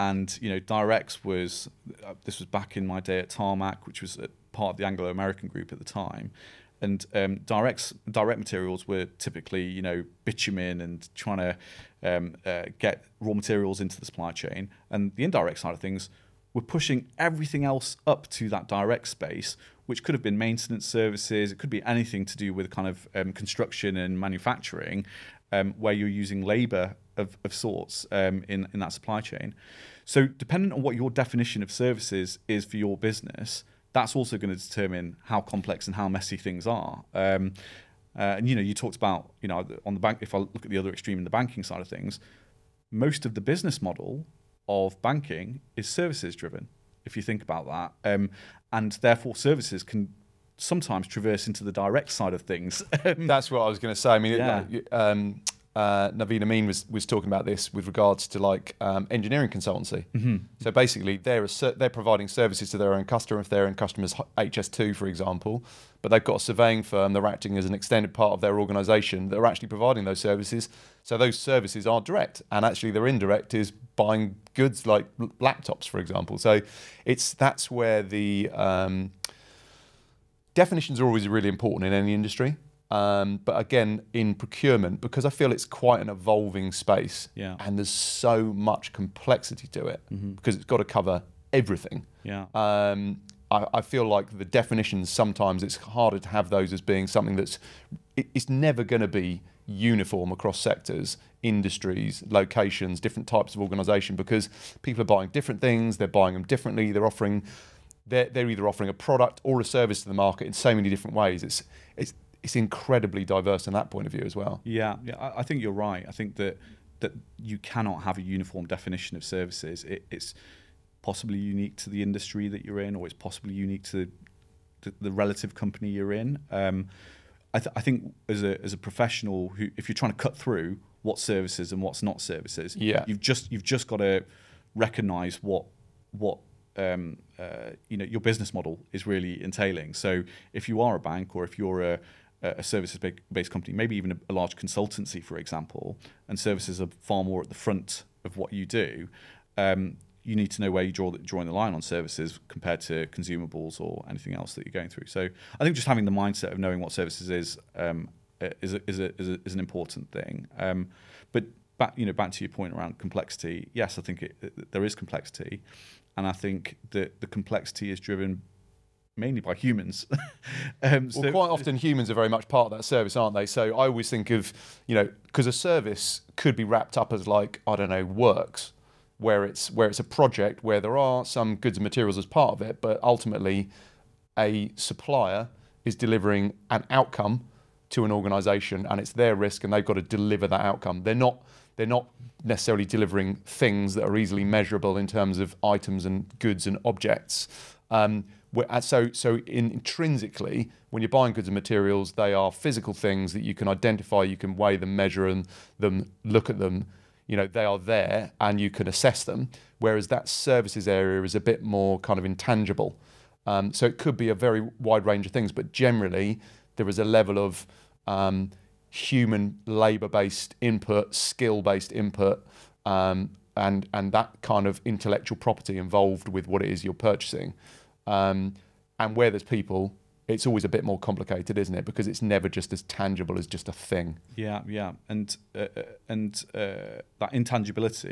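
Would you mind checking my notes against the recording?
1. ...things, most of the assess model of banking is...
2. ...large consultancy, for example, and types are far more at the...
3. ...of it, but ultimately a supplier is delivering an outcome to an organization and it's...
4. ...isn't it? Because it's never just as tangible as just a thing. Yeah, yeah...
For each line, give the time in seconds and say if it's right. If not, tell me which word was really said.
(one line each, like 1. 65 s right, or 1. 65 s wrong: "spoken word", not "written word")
1. 41 s wrong: "business", not "assess"
2. 144 s wrong: "services", not "types"
3. 182 s right
4. 231 s right.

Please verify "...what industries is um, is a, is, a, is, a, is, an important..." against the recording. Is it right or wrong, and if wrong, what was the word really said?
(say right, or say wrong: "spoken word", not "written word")
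wrong: "services", not "industries".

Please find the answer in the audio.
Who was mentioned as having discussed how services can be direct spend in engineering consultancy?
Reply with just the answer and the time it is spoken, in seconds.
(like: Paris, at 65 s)
Naveen Amin, at 56 s.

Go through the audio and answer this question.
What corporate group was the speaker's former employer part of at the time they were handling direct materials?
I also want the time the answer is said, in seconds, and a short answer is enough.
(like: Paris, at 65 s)
Anglo American, at 4 s.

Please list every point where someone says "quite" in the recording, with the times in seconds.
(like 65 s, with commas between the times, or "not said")
85 s, 171 s.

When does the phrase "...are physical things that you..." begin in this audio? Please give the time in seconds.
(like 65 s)
202 s.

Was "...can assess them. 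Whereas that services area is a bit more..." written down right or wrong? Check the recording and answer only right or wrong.
right.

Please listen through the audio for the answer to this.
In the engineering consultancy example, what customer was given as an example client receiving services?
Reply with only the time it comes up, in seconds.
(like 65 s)
64 s.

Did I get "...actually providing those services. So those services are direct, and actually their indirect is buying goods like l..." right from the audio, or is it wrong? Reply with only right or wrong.
right.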